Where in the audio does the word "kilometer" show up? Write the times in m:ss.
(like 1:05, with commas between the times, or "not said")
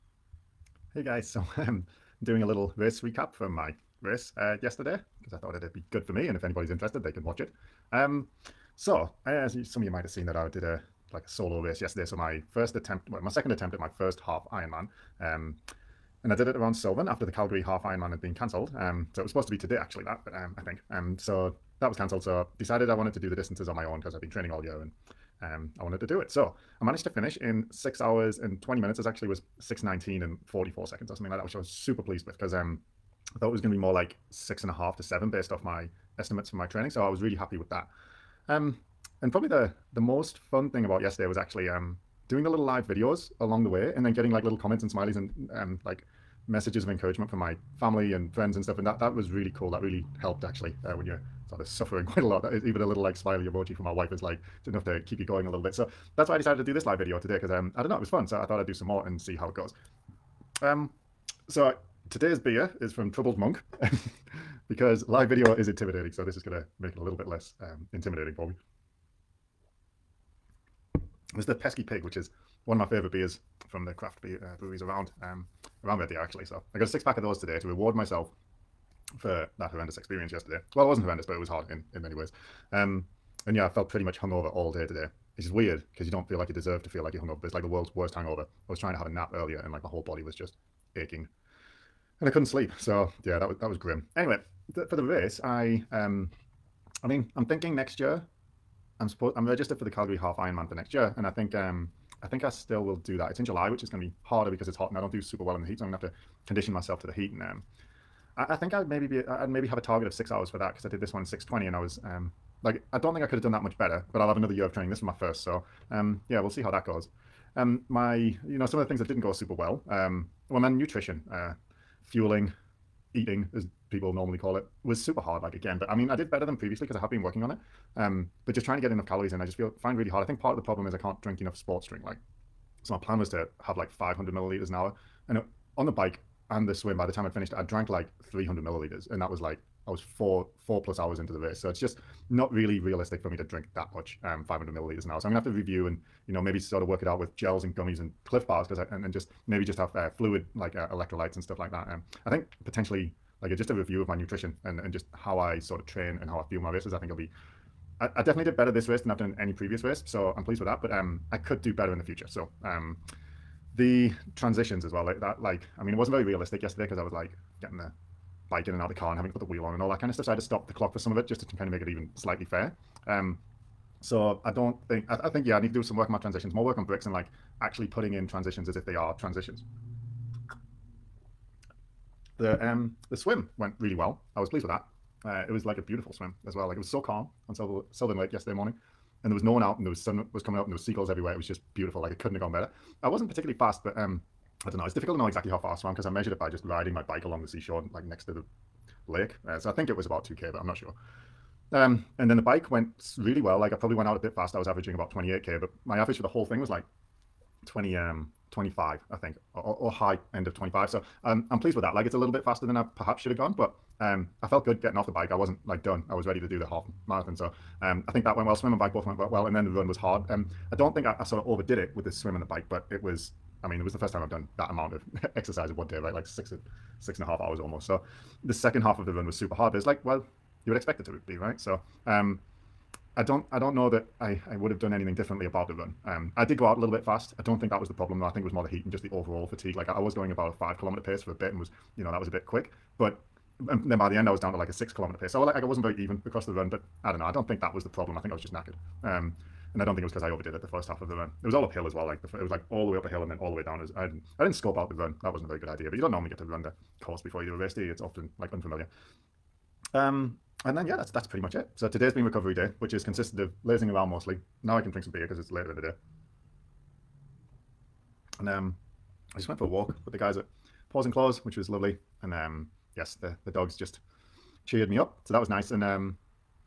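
4:00, 4:04.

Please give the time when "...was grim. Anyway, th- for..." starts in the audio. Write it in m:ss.
1:33.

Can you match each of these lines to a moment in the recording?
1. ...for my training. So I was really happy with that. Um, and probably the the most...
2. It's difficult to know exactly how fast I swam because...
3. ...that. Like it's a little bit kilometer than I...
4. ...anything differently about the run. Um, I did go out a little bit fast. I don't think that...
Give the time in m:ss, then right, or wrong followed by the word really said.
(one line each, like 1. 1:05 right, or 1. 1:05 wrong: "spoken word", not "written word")
1. 0:36 right
2. 3:14 right
3. 3:31 wrong: "faster", not "kilometer"
4. 3:54 right.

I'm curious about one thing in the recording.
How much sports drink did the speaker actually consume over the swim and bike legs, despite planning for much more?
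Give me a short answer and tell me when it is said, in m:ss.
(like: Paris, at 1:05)
300 milliliters, at 2:18.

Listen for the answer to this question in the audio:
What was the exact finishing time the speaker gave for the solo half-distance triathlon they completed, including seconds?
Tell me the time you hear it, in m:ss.
0:29.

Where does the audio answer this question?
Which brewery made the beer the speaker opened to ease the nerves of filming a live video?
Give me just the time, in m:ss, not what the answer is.
1:03.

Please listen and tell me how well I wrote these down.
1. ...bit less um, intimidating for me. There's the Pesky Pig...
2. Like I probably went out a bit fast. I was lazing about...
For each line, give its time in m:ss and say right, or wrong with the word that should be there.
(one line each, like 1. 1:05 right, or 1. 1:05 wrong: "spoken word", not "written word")
1. 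1:07 right
2. 3:23 wrong: "averaging", not "lazing".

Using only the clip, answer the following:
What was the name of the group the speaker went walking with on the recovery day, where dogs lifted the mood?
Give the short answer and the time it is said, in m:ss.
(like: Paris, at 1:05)
Paws and Claws, at 4:30.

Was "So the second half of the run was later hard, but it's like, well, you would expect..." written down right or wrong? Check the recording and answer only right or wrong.
wrong.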